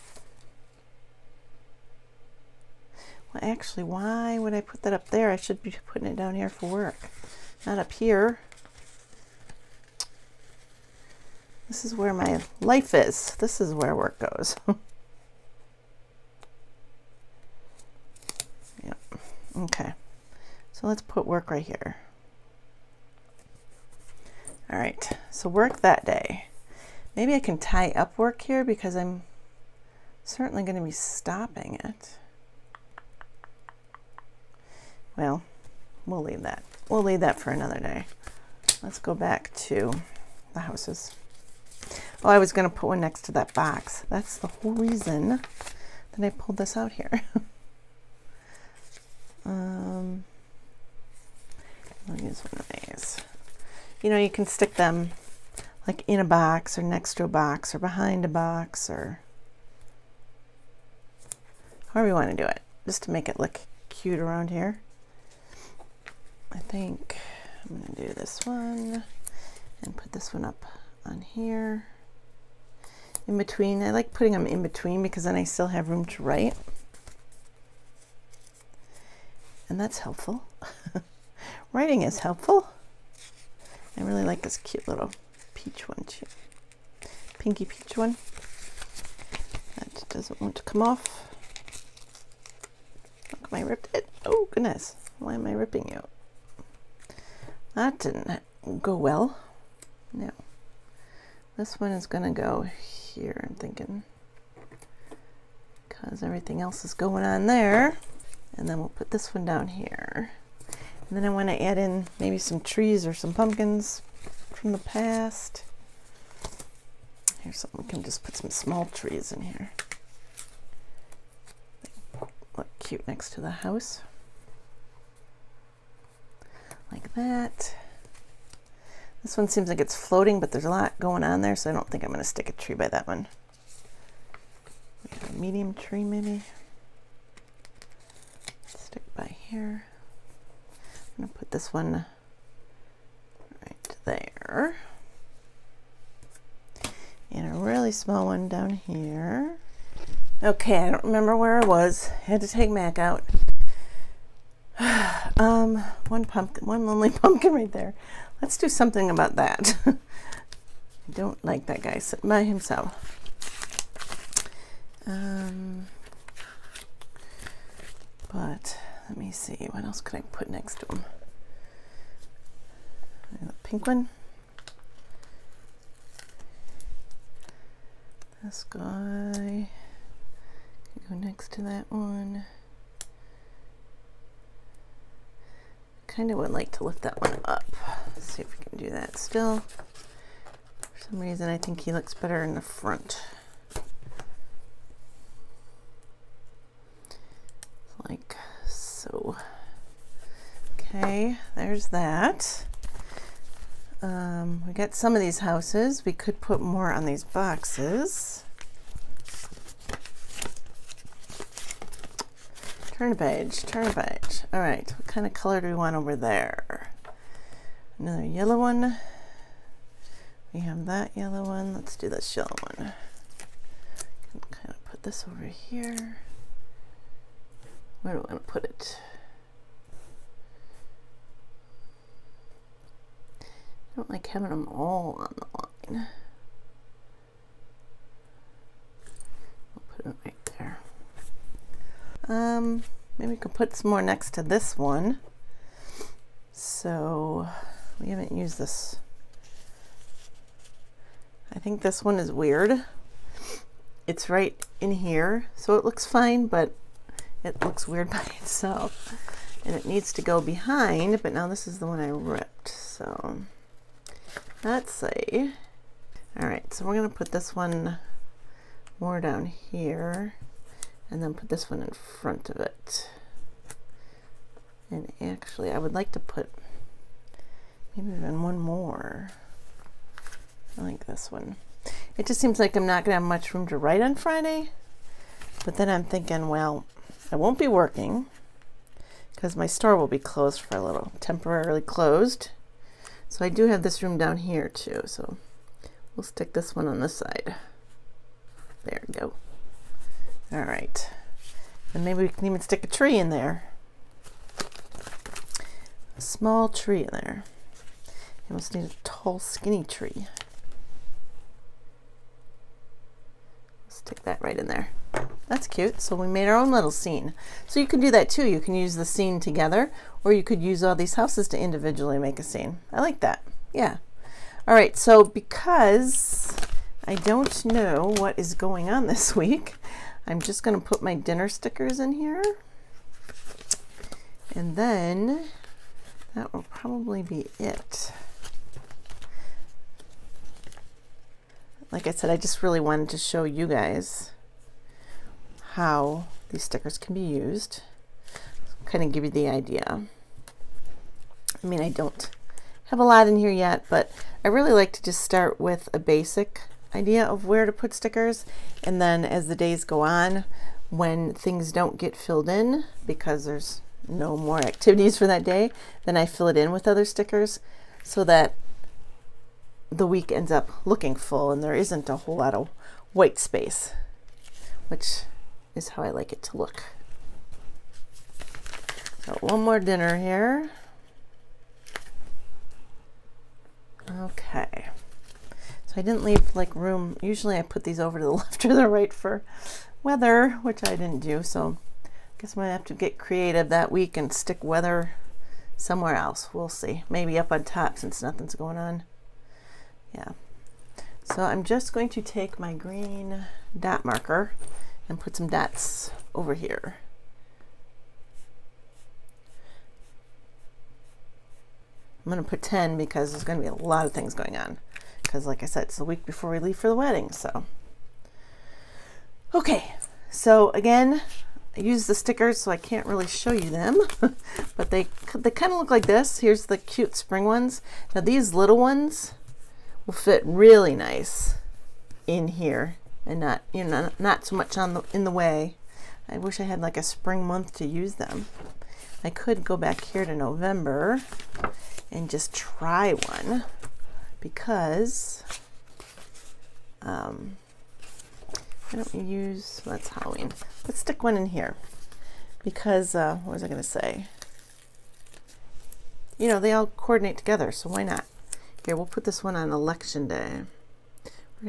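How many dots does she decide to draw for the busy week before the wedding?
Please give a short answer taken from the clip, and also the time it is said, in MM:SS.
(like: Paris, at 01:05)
10, at 06:52.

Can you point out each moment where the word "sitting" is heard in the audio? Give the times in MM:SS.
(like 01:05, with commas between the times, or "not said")
02:41.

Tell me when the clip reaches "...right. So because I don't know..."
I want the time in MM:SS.
05:24.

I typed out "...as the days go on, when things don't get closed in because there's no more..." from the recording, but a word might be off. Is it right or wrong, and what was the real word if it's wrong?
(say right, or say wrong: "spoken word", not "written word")
wrong: "filled", not "closed".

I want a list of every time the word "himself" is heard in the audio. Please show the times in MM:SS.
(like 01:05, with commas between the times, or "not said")
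02:42.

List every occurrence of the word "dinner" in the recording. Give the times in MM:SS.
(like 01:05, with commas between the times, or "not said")
05:31, 06:19.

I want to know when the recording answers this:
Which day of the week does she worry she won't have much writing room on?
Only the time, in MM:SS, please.
04:44.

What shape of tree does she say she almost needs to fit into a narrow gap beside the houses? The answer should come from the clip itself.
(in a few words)
tall, skinny tree.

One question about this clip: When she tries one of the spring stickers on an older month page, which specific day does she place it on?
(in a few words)
election day.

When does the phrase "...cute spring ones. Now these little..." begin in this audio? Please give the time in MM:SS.
07:06.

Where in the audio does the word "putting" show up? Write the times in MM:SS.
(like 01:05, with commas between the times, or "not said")
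00:05, 01:14.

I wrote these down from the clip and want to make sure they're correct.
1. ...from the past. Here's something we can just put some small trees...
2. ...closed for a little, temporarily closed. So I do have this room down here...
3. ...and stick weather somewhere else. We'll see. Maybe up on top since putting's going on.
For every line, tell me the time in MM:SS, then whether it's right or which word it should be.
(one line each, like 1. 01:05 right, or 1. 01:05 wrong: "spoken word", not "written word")
1. 01:54 right
2. 04:50 right
3. 06:34 wrong: "nothing", not "putting".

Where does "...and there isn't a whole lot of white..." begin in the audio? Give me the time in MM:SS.
06:11.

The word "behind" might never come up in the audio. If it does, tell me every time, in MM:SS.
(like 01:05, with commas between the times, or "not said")
00:57, 04:20.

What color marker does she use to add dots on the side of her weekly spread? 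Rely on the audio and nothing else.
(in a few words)
green.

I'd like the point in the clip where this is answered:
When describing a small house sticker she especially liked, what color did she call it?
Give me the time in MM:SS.
01:27.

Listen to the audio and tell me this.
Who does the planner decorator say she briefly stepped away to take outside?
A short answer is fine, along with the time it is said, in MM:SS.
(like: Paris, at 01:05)
Mac, at 02:32.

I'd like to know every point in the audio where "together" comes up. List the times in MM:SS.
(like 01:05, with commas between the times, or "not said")
05:19, 07:37.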